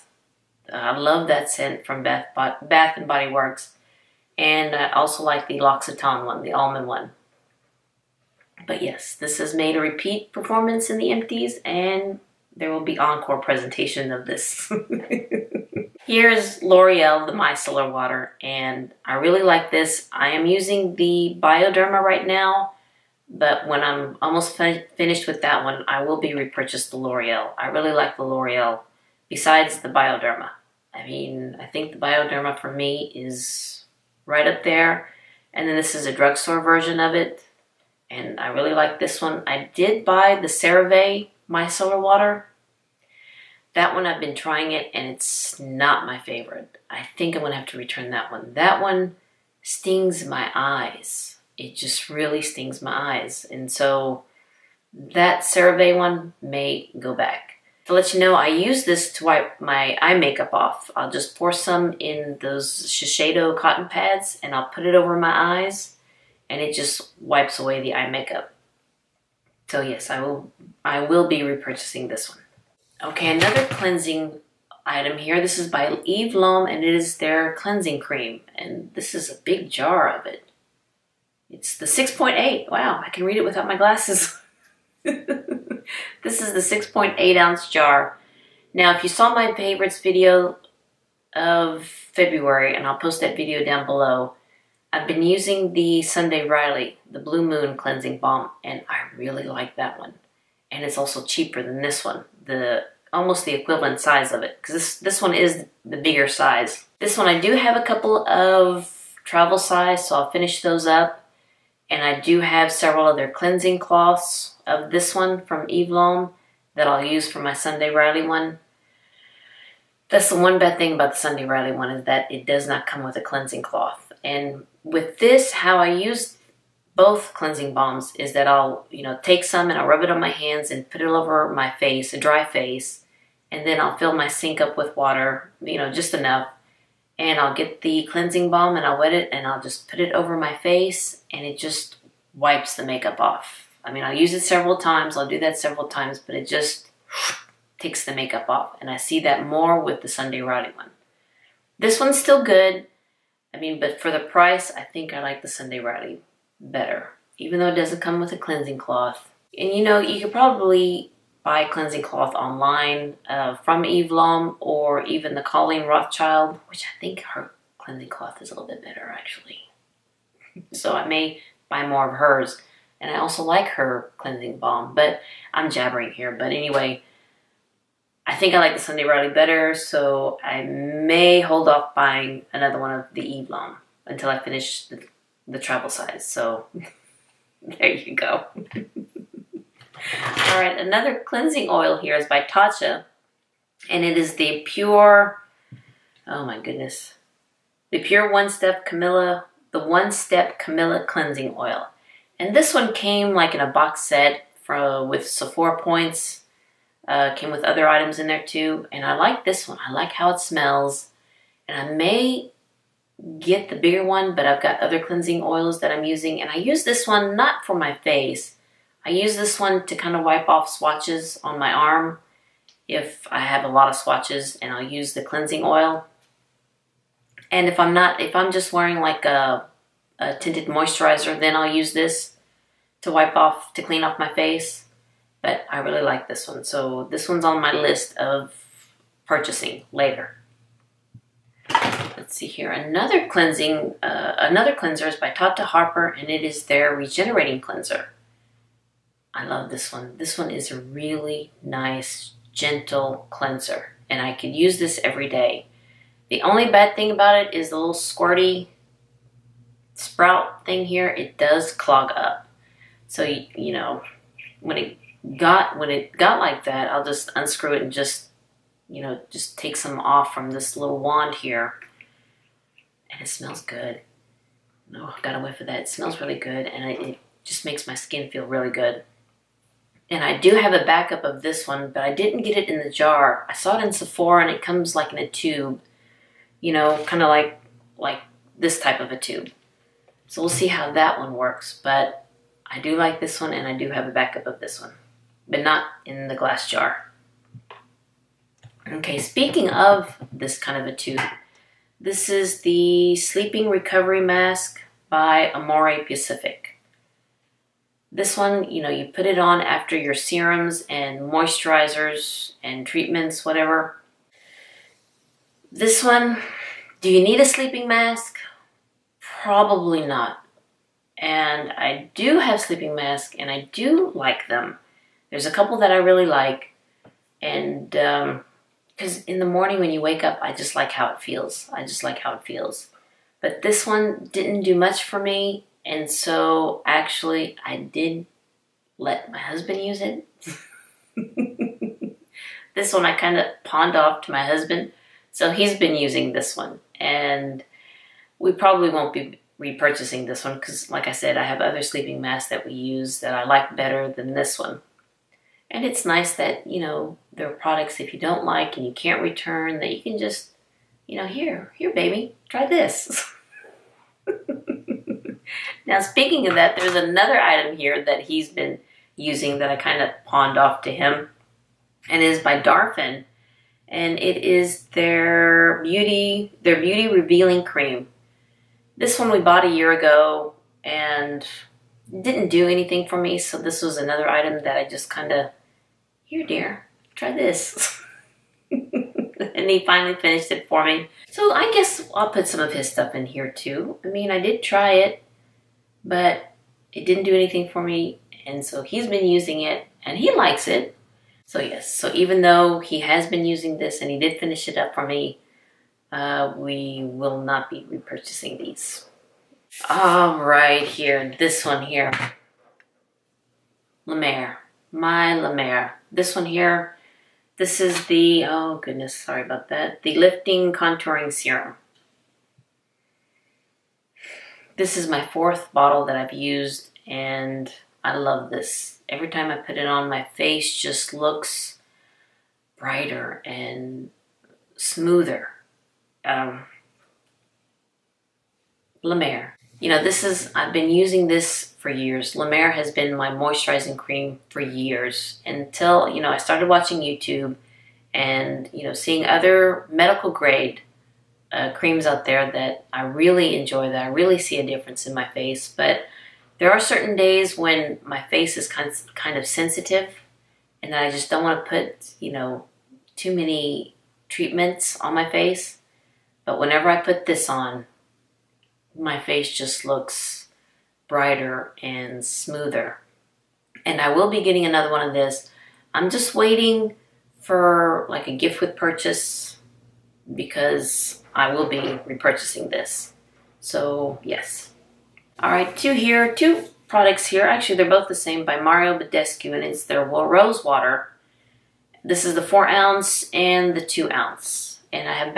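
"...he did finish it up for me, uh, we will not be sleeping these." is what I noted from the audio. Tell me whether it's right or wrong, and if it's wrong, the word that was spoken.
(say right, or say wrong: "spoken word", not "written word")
wrong: "repurchasing", not "sleeping".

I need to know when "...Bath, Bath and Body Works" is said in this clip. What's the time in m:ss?
0:02.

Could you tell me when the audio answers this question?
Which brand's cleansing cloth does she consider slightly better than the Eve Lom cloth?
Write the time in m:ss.
2:45.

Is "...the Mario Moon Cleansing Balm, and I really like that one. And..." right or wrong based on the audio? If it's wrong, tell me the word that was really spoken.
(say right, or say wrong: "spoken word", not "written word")
wrong: "Blue", not "Mario".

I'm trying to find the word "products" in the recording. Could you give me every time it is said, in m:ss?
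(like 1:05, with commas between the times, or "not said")
5:57, 8:06.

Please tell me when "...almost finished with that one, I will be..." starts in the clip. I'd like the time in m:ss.
0:24.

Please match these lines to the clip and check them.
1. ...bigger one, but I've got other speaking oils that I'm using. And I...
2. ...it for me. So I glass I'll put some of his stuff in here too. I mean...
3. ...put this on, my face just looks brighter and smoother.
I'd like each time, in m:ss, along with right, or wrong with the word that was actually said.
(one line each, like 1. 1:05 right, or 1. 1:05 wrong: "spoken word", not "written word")
1. 3:33 wrong: "cleansing", not "speaking"
2. 6:30 wrong: "guess", not "glass"
3. 7:46 right.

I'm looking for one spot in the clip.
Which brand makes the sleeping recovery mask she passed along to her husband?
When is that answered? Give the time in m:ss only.
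5:05.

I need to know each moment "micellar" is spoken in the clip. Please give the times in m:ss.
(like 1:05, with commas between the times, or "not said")
0:17, 0:41.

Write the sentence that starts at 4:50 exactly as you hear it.
So we'll see how that one works.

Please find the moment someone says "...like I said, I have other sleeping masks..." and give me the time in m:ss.
5:50.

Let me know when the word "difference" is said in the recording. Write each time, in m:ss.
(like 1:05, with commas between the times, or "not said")
7:34.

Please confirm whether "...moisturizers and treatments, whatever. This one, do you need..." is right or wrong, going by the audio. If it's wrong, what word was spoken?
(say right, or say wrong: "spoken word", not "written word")
right.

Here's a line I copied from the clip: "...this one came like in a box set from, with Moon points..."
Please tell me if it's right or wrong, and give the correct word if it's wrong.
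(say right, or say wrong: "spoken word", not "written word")
wrong: "Sephora", not "Moon".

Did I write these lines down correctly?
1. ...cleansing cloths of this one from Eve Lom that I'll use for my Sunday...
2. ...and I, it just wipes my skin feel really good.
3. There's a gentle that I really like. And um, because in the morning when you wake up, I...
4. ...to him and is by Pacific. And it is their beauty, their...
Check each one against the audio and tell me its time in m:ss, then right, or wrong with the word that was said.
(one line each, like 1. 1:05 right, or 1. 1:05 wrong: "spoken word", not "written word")
1. 1:53 right
2. 4:36 wrong: "makes", not "wipes"
3. 5:25 wrong: "couple", not "gentle"
4. 6:10 wrong: "Darphin", not "Pacific".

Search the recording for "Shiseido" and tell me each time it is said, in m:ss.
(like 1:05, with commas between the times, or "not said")
1:02.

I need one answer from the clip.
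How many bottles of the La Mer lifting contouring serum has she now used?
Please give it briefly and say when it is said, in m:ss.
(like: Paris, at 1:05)
4, at 7:05.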